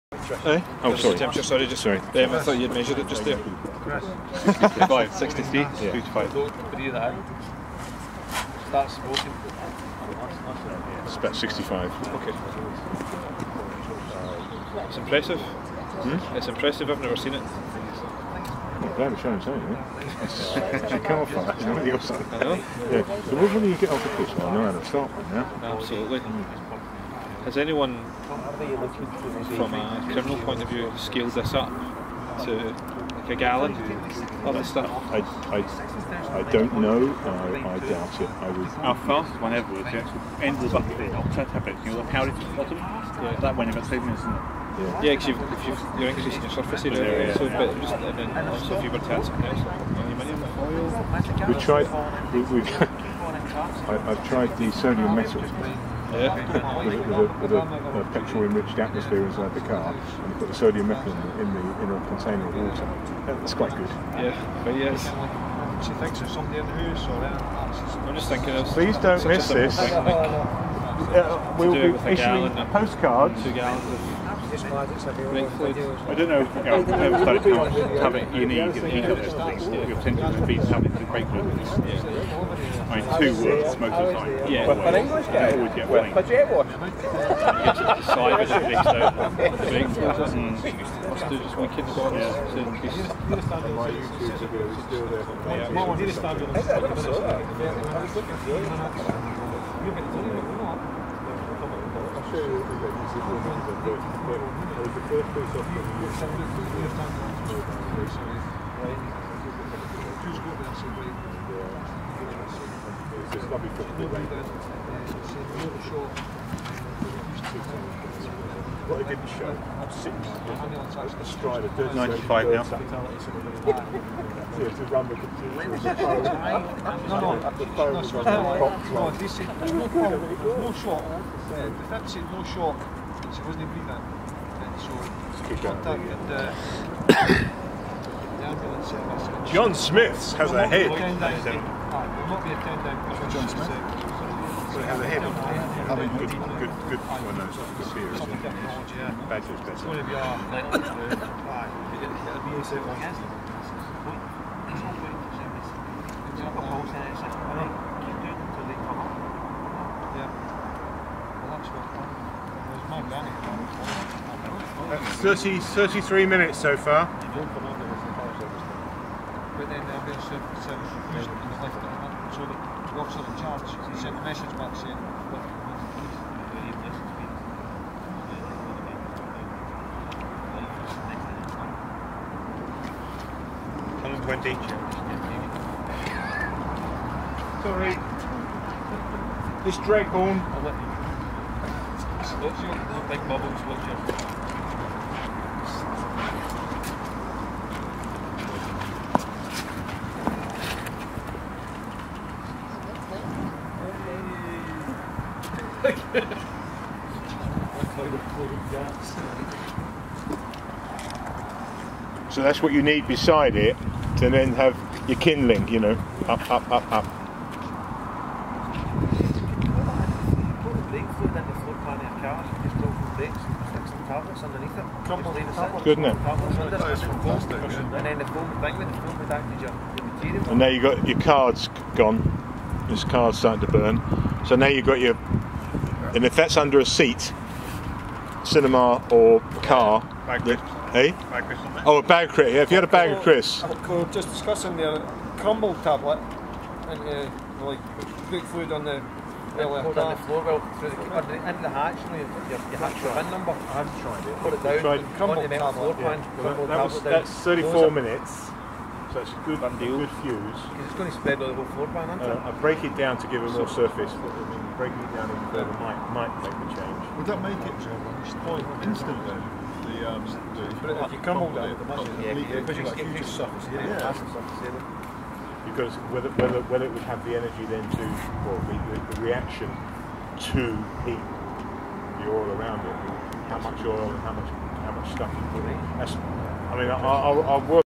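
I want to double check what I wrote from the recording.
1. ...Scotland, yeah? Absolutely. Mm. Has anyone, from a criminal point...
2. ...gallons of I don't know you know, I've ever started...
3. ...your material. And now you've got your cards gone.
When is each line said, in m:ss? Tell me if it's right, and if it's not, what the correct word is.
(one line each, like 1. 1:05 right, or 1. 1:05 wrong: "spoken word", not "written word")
1. 0:24 right
2. 1:13 right
3. 3:49 right.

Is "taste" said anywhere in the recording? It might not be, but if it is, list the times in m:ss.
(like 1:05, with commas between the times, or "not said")
not said.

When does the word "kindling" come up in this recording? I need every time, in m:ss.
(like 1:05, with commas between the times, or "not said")
3:35.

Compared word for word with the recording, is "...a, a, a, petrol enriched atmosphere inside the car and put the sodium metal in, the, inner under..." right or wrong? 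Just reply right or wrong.
wrong.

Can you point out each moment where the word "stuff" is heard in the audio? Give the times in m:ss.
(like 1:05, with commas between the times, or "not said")
0:34, 4:45.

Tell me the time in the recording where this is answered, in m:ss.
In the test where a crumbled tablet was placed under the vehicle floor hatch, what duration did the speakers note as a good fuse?
4:17.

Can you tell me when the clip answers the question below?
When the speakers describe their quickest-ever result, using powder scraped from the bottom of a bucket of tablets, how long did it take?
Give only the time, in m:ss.
0:43.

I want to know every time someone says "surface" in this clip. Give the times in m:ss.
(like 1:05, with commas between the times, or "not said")
0:46, 4:23, 4:33.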